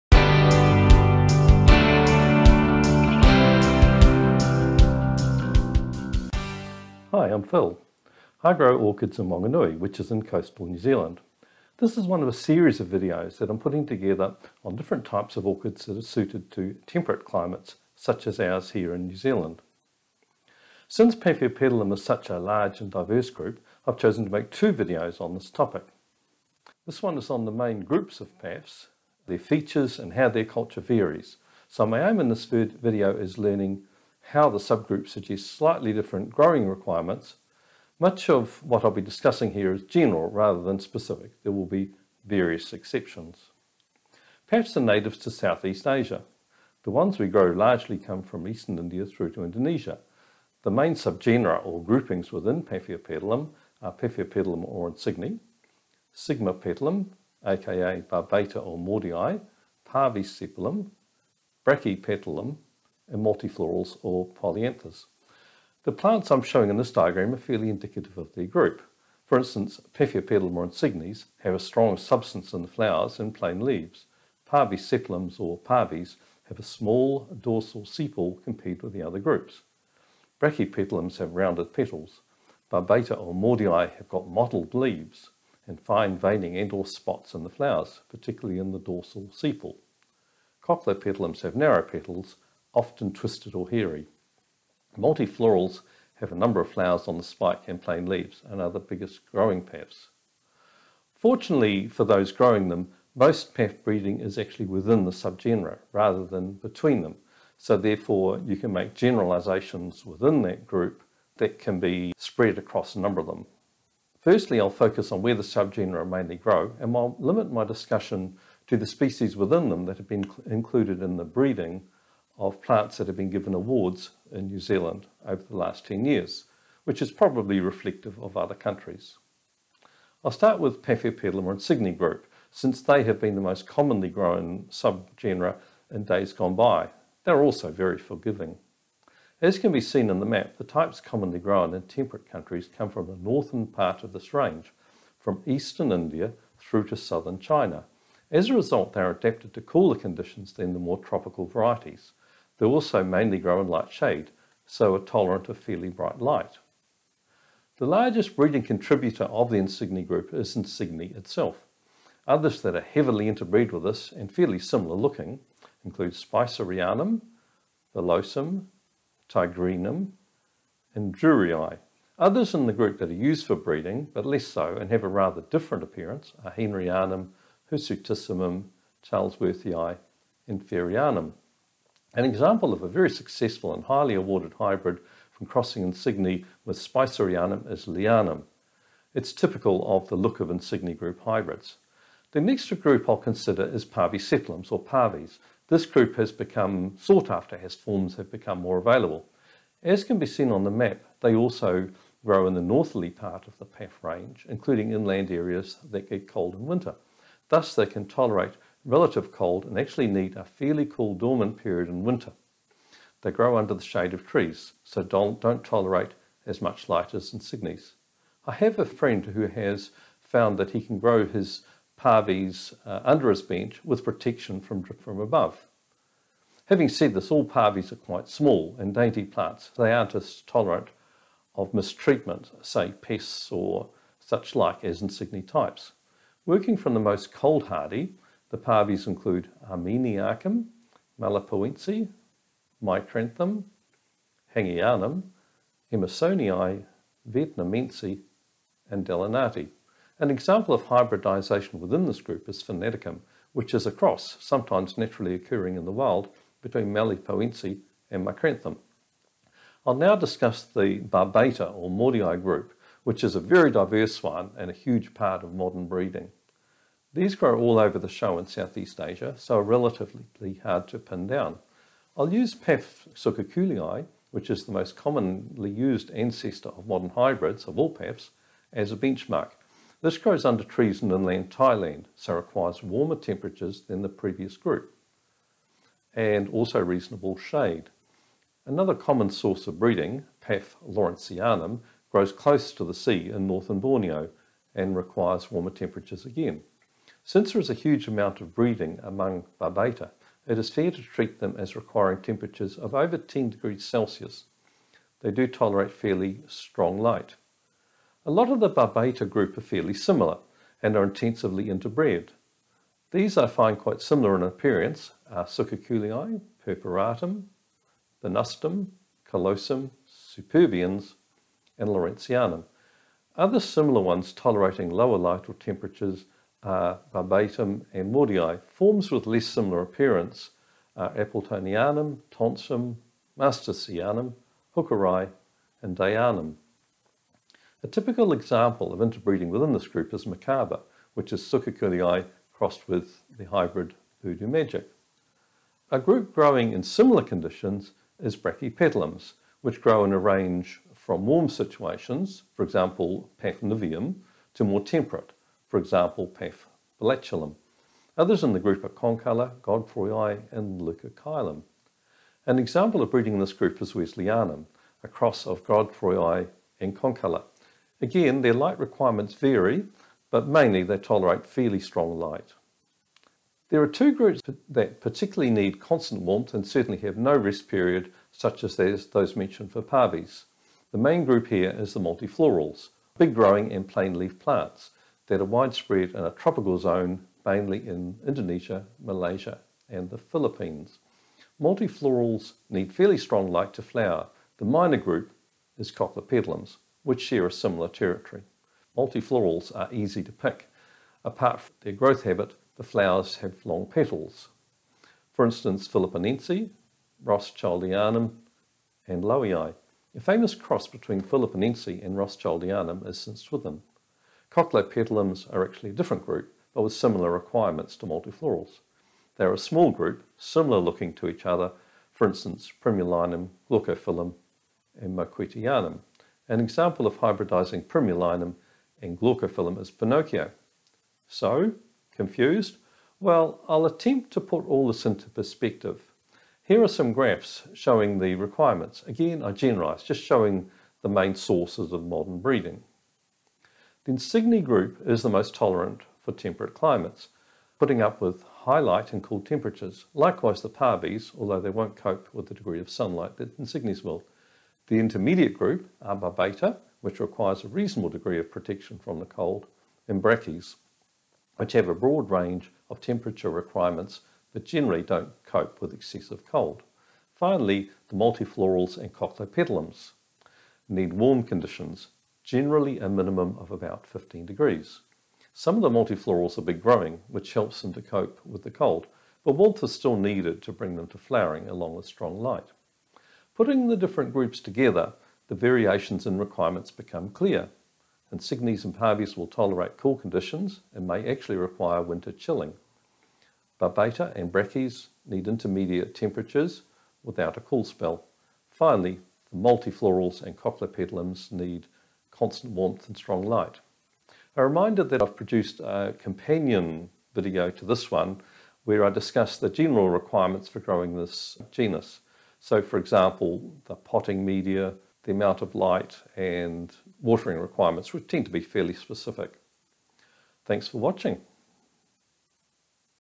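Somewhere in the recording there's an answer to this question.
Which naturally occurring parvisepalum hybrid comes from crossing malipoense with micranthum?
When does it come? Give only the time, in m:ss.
4:12.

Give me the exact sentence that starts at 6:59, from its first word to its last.
They're a small group, similar looking to each other, for instance, primulinum, glaucophyllum, and moquetteanum.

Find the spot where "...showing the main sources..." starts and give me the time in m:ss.
7:20.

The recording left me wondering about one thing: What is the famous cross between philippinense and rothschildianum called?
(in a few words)
St. Swithin.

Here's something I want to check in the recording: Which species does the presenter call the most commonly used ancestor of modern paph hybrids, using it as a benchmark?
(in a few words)
Paph sukhakulii.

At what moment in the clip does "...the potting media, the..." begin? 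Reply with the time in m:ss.
8:33.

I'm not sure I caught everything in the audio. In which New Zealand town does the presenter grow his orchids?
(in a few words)
Whanganui.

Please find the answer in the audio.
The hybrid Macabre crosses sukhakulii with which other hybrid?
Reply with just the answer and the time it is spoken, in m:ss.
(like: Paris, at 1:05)
Voodoo Magic, at 5:44.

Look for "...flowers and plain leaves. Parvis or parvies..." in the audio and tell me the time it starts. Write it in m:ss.
1:12.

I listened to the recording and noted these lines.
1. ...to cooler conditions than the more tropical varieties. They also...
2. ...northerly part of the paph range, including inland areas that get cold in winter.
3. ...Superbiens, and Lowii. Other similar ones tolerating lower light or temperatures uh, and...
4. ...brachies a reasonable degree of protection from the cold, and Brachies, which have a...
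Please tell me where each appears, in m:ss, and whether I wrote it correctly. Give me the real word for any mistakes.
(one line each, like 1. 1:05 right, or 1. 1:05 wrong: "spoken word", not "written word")
1. 2:29 right
2. 3:22 right
3. 5:20 wrong: "Lawrenceanum", not "Lowii"
4. 7:37 wrong: "requires", not "brachies".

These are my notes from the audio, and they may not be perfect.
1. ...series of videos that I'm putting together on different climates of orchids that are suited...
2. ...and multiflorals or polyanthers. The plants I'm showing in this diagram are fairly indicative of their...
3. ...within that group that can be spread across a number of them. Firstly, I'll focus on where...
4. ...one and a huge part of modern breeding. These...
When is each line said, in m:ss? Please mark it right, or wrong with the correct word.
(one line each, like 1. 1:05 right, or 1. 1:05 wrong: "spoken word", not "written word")
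1. 0:12 wrong: "types", not "climates"
2. 1:03 right
3. 1:50 right
4. 4:24 right.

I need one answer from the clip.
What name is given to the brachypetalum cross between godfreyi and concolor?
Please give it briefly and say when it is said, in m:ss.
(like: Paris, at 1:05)
Wellesleyanum, at 6:03.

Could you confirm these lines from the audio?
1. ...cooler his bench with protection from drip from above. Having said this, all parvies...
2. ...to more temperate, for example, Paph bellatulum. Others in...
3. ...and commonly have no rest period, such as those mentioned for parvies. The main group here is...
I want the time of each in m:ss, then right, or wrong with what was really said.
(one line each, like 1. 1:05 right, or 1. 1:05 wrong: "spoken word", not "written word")
1. 3:43 wrong: "under", not "cooler"
2. 5:54 right
3. 6:16 wrong: "certainly", not "commonly".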